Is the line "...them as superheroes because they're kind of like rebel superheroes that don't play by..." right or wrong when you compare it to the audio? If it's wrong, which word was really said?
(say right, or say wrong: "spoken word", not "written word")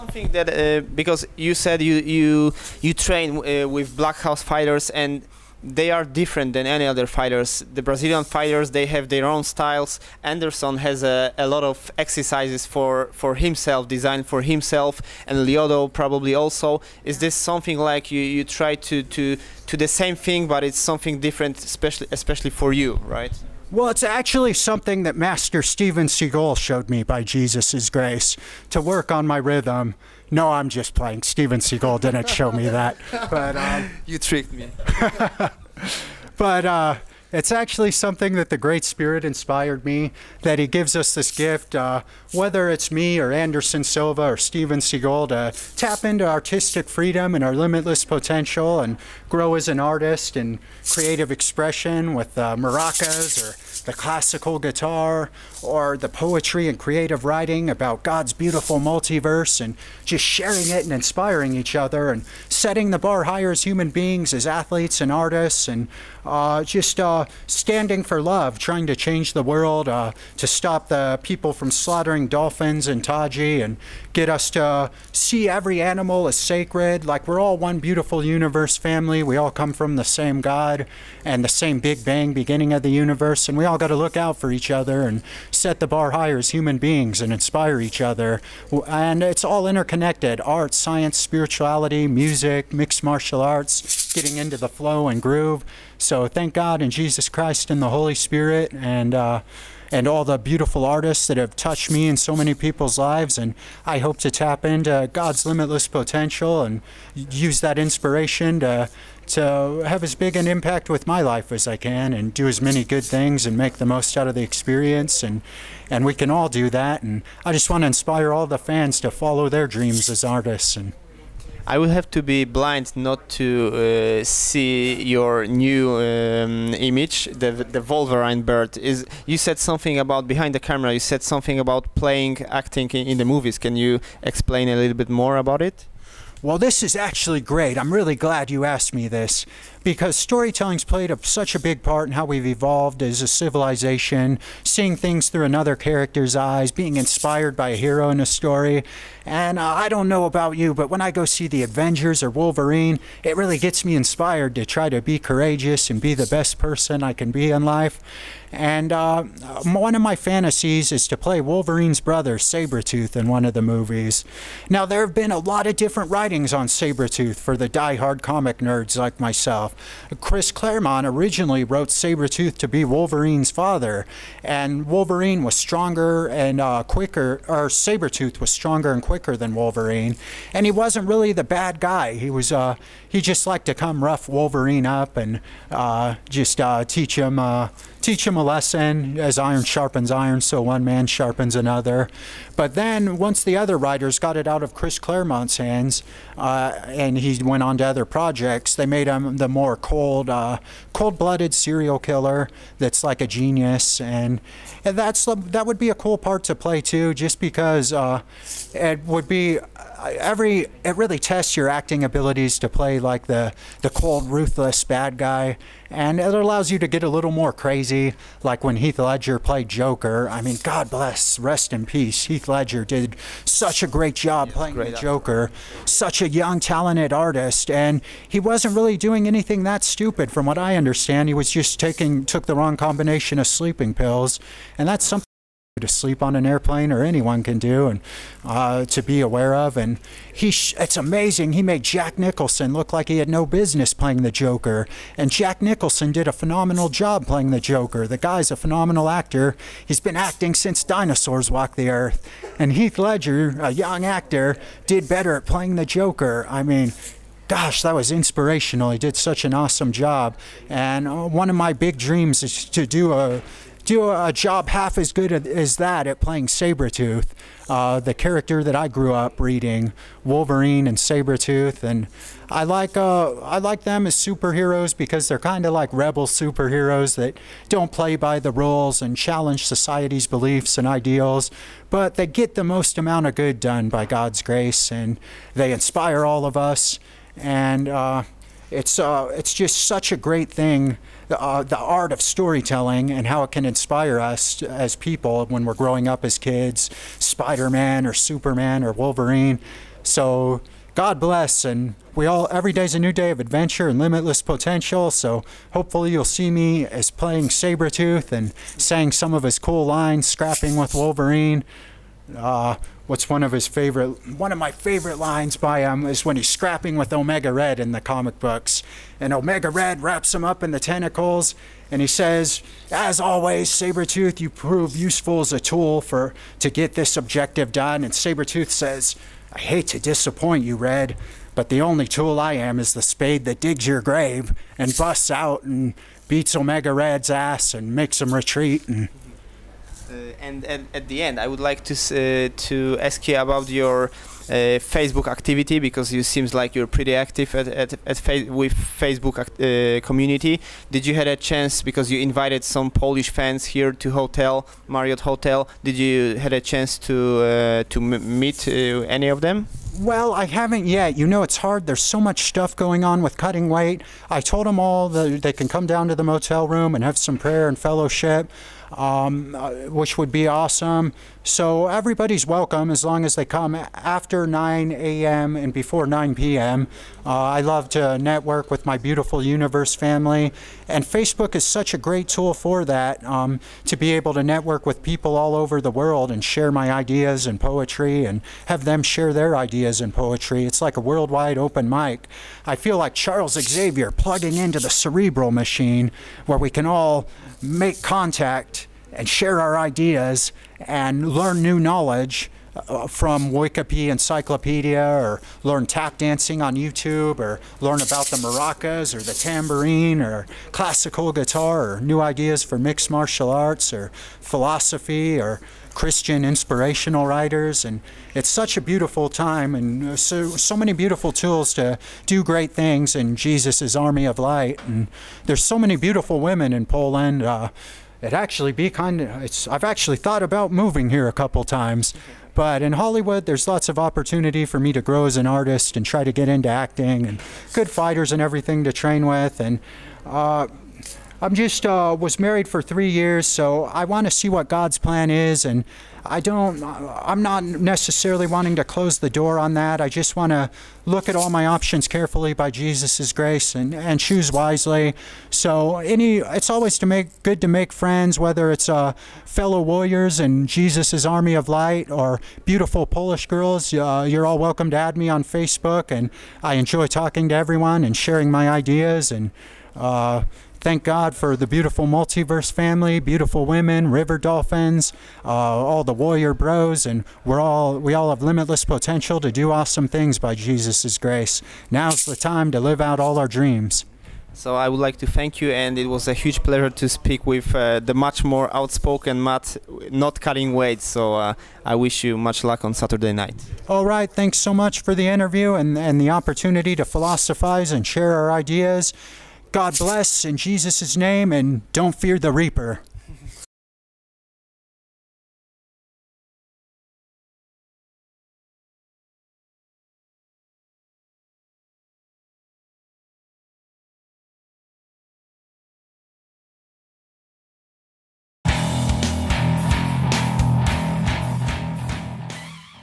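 right.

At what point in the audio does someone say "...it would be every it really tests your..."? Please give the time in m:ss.
3:28.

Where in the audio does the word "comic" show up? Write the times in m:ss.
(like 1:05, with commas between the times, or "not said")
2:48, 5:17.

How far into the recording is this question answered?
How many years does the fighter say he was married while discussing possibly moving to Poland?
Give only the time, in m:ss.
7:22.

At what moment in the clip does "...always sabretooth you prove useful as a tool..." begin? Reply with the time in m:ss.
5:23.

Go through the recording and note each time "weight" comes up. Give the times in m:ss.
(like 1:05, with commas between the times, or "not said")
6:03, 8:10.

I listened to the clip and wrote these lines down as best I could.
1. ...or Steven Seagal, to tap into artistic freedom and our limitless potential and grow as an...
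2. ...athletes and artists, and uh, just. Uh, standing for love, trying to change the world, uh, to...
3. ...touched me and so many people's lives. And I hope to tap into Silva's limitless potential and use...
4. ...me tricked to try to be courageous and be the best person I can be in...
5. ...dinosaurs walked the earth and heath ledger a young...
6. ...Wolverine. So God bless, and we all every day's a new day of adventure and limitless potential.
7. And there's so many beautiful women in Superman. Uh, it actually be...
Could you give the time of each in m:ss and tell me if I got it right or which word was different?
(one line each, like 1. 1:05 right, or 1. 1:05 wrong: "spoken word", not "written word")
1. 0:44 right
2. 1:04 right
3. 1:41 wrong: "God", not "Silva"
4. 2:33 wrong: "inspired", not "tricked"
5. 4:10 right
6. 4:58 right
7. 7:04 wrong: "Poland", not "Superman".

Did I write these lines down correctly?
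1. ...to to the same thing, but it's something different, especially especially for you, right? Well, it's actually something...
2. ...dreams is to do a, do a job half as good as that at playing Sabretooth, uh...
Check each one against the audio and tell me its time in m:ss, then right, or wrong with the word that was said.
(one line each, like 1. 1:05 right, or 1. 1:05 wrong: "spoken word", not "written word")
1. 0:19 right
2. 4:21 right.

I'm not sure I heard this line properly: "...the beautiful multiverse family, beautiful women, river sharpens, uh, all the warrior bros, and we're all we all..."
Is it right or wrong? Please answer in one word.
wrong.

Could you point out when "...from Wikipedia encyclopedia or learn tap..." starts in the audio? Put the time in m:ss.
6:43.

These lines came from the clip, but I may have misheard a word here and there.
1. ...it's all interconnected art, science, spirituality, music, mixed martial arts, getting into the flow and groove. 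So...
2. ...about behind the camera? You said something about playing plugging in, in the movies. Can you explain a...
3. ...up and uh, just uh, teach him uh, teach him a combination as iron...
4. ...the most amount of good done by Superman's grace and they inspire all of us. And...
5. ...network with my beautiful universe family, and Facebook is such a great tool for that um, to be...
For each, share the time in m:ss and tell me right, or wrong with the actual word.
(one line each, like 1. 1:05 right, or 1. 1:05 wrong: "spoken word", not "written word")
1. 1:29 right
2. 2:09 wrong: "acting", not "plugging"
3. 3:04 wrong: "lesson", not "combination"
4. 4:42 wrong: "God", not "Superman"
5. 6:18 right.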